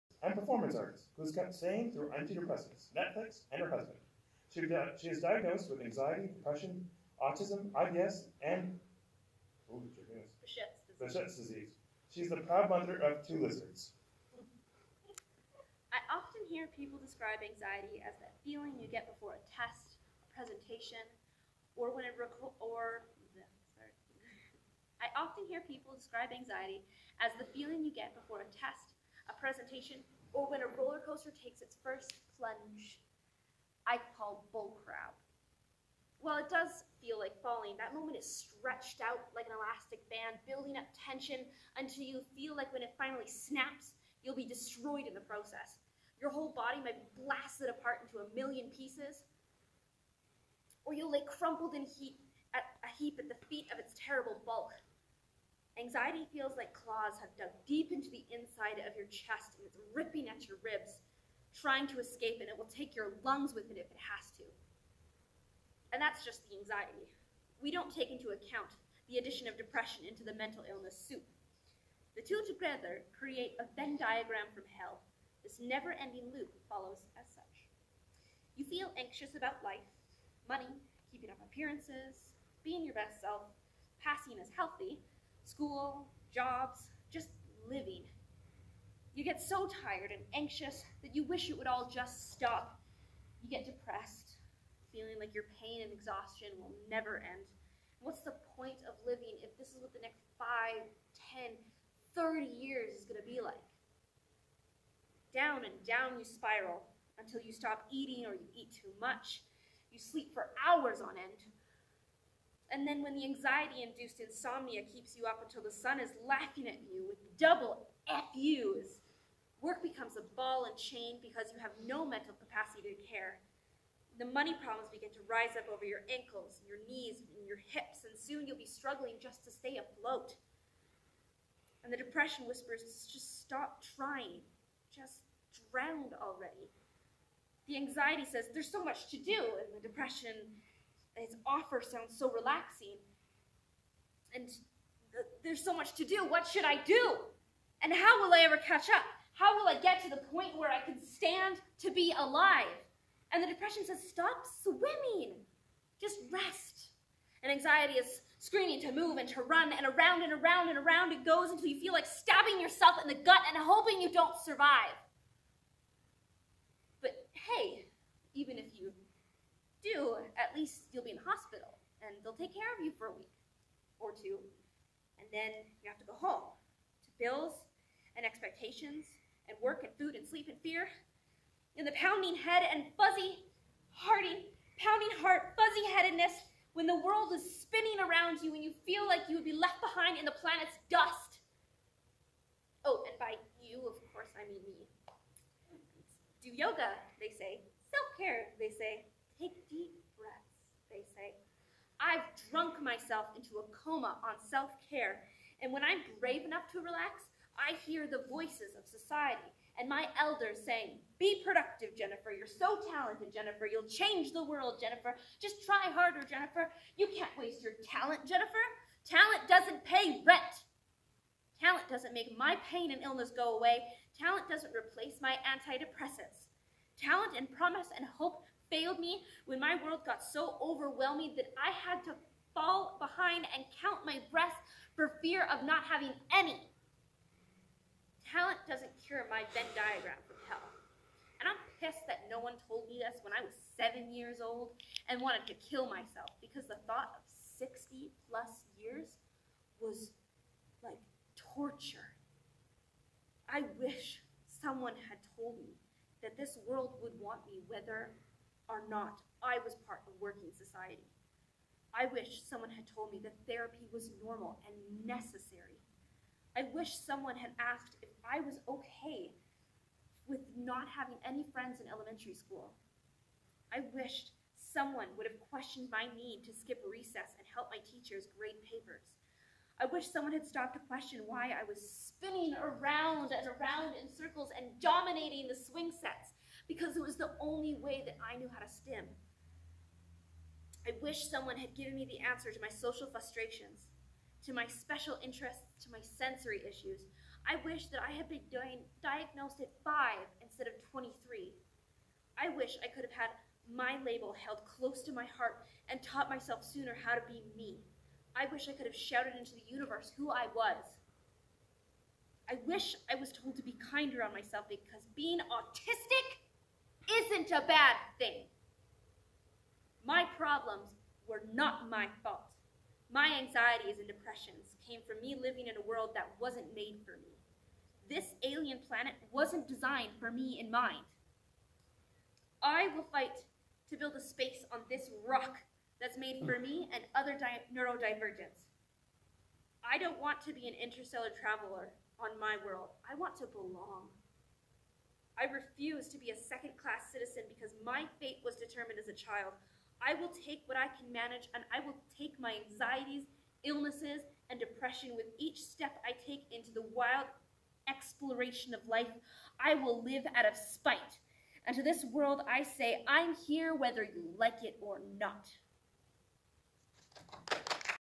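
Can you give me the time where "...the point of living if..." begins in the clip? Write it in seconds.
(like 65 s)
98 s.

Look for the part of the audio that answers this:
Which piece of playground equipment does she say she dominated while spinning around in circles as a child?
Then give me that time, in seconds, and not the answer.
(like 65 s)
285 s.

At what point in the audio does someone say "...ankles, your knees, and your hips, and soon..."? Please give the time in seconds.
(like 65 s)
126 s.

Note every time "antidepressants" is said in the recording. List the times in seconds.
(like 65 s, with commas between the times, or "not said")
2 s, 225 s.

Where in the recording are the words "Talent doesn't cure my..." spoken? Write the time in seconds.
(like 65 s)
238 s.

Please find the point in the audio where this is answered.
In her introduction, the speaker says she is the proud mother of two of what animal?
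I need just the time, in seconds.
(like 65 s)
13 s.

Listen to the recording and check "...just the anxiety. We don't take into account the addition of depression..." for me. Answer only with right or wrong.
right.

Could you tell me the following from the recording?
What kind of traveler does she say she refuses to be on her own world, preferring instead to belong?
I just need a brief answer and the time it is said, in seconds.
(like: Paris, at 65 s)
interstellar traveler, at 340 s.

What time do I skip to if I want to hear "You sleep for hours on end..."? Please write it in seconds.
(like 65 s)
109 s.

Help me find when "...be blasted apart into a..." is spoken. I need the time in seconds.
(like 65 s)
47 s.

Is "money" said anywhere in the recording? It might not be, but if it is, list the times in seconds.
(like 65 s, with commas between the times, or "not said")
80 s, 124 s.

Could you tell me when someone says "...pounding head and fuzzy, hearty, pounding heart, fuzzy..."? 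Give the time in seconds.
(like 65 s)
181 s.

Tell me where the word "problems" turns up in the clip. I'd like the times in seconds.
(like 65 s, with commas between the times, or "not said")
124 s, 320 s.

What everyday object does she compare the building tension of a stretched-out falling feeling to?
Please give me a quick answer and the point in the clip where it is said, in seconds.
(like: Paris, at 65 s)
an elastic band, at 39 s.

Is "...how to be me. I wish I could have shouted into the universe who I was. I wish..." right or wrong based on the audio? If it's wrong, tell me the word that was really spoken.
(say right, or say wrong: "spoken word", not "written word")
right.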